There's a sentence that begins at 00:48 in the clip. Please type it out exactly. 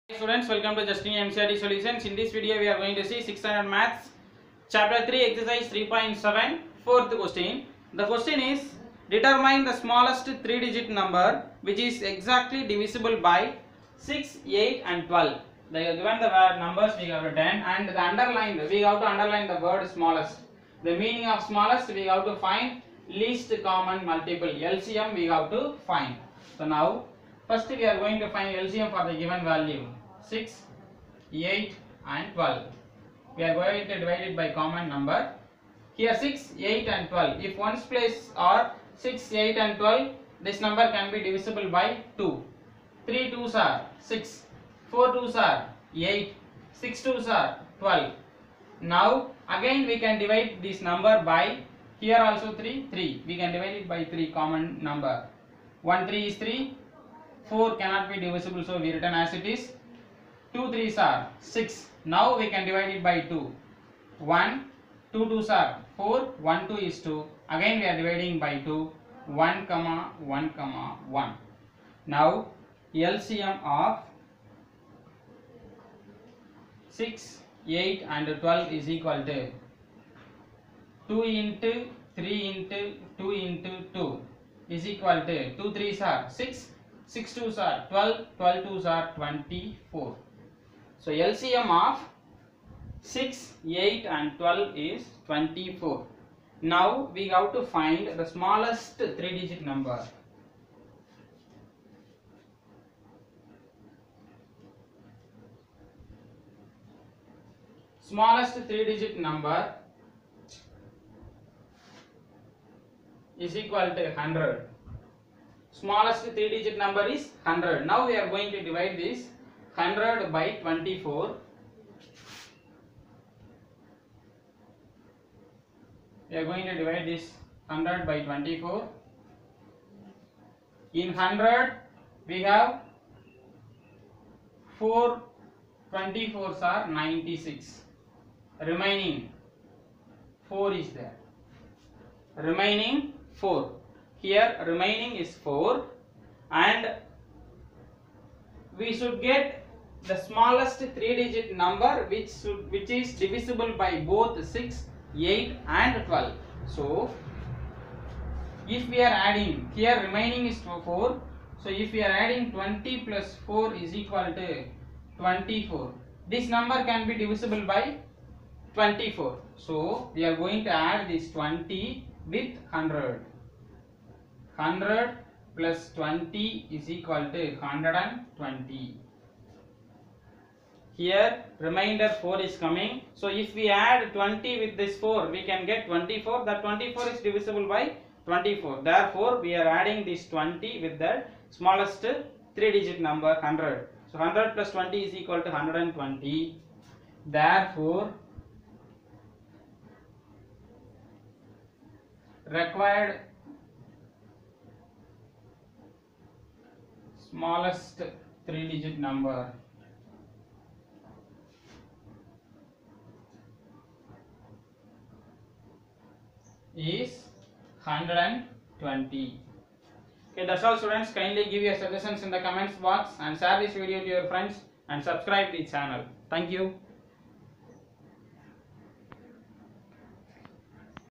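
Now again we can divide this number by here also 3, 3.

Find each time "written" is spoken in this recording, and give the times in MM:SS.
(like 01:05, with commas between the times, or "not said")
00:17, 00:58.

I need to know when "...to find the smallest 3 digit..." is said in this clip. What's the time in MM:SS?
01:37.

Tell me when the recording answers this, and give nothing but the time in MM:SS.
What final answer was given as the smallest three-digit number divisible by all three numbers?
03:36.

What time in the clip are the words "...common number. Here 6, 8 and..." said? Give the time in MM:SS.
00:34.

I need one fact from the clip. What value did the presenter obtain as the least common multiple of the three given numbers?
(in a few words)
24.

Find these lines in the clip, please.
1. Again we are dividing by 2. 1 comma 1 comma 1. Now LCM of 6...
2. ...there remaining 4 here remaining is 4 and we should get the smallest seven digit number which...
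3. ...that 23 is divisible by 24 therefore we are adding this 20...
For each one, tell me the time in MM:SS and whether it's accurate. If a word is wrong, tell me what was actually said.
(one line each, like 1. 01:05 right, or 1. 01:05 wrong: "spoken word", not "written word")
1. 01:07 right
2. 02:20 wrong: "three", not "seven"
3. 03:06 wrong: "24", not "23".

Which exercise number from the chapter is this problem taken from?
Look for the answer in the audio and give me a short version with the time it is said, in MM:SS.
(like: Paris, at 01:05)
3.7, at 00:05.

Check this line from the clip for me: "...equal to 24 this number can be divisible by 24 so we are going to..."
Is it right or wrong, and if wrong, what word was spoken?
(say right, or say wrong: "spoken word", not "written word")
right.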